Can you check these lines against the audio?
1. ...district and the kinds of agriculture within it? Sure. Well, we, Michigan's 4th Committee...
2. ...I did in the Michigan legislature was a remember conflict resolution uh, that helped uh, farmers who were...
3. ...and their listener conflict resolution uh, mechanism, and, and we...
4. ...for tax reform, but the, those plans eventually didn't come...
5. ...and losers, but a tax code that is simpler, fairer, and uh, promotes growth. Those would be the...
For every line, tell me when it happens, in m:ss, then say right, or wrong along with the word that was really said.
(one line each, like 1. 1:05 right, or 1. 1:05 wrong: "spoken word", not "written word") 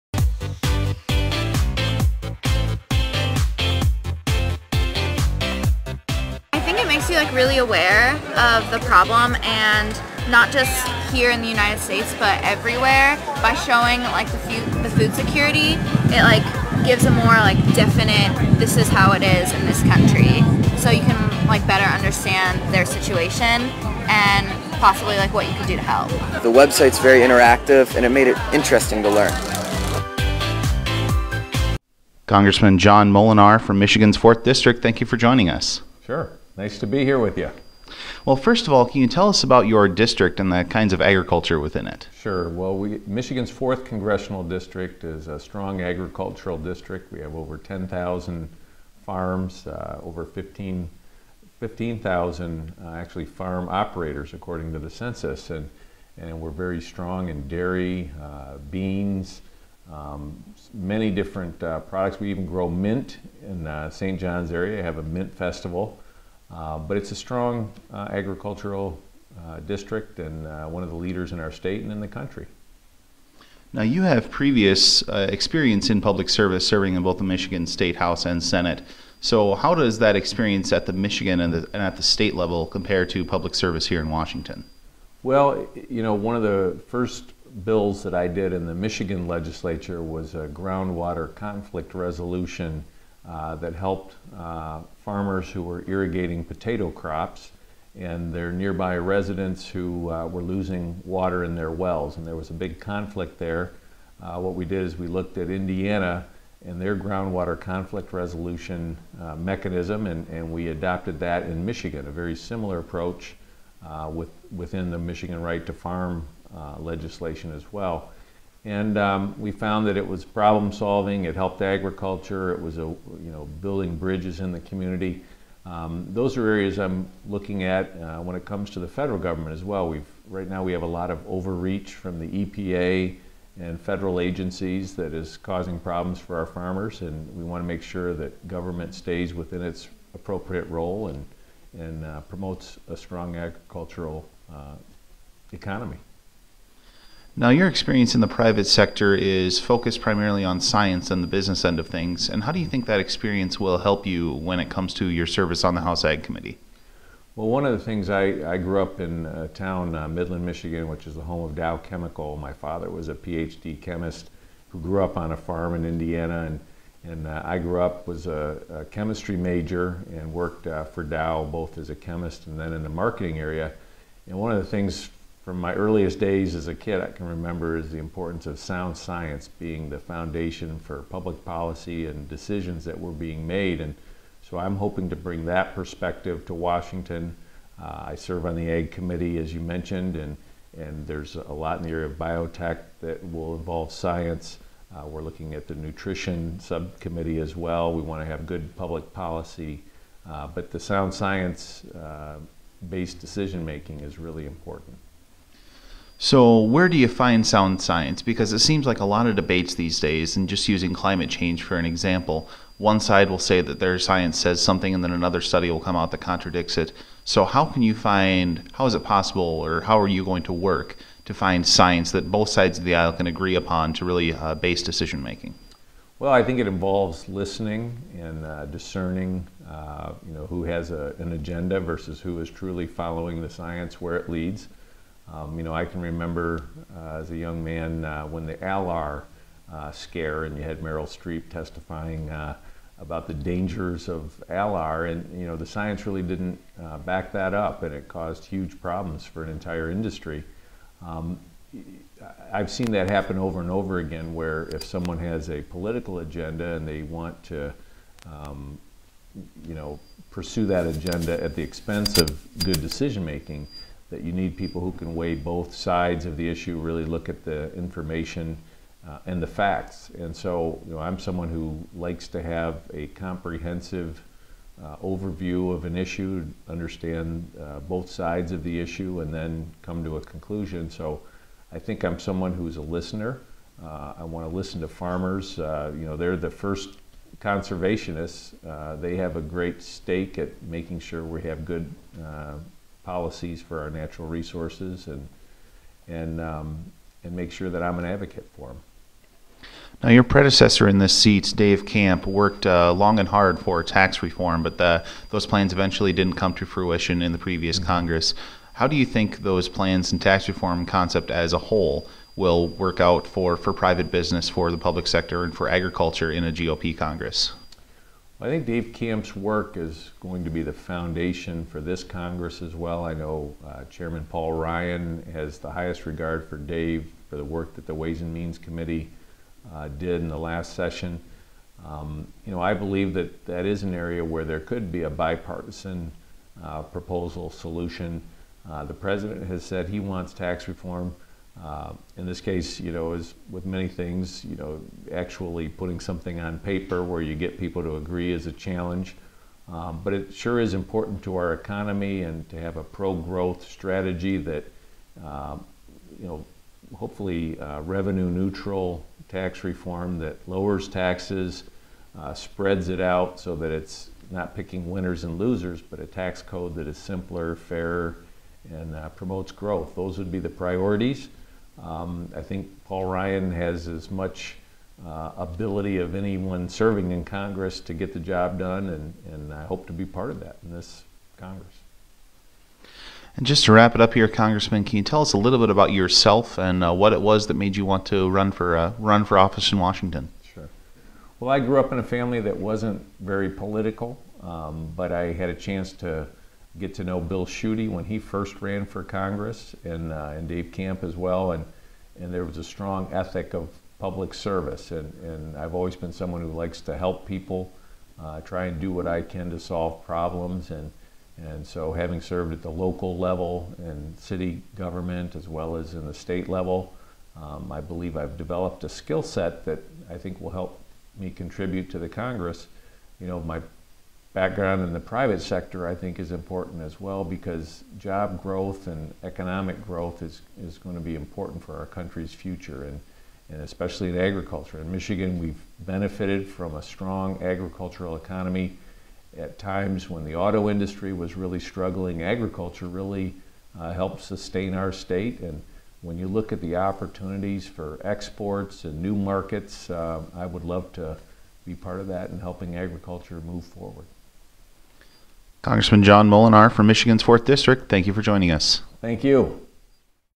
1. 0:39 wrong: "Congressional", not "Committee"
2. 1:28 wrong: "groundwater", not "remember"
3. 1:46 wrong: "groundwater", not "listener"
4. 5:03 right
5. 6:05 right.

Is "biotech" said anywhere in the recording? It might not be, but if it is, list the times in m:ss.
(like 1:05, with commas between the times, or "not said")
3:12.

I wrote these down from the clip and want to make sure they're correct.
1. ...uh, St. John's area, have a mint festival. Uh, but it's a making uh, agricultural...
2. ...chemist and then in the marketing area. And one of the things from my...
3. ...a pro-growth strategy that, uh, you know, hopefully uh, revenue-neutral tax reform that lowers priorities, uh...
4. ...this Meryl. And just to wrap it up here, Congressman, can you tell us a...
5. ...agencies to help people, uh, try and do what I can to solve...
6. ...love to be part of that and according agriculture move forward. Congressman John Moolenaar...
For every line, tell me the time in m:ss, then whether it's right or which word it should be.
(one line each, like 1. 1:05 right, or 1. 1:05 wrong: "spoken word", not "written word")
1. 1:03 wrong: "strong", not "making"
2. 2:51 right
3. 5:52 wrong: "taxes", not "priorities"
4. 6:20 wrong: "Congress", not "Meryl"
5. 6:46 wrong: "likes", not "agencies"
6. 7:30 wrong: "helping", not "according".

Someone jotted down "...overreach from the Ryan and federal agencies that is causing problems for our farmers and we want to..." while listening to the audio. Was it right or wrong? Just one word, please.
wrong.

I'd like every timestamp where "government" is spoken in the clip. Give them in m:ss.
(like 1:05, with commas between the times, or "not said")
2:09, 2:18, 6:54.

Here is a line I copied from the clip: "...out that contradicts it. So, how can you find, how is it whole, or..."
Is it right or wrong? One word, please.
wrong.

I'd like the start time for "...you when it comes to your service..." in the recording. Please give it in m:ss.
2:34.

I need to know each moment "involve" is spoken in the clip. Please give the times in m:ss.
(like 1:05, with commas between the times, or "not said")
3:13, 3:46.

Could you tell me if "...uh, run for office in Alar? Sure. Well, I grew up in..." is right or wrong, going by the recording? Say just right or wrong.
wrong.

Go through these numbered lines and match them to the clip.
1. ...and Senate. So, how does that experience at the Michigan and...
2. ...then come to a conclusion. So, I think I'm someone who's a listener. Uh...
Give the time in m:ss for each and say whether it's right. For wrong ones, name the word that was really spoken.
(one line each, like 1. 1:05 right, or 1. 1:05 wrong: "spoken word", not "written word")
1. 1:18 right
2. 4:39 right.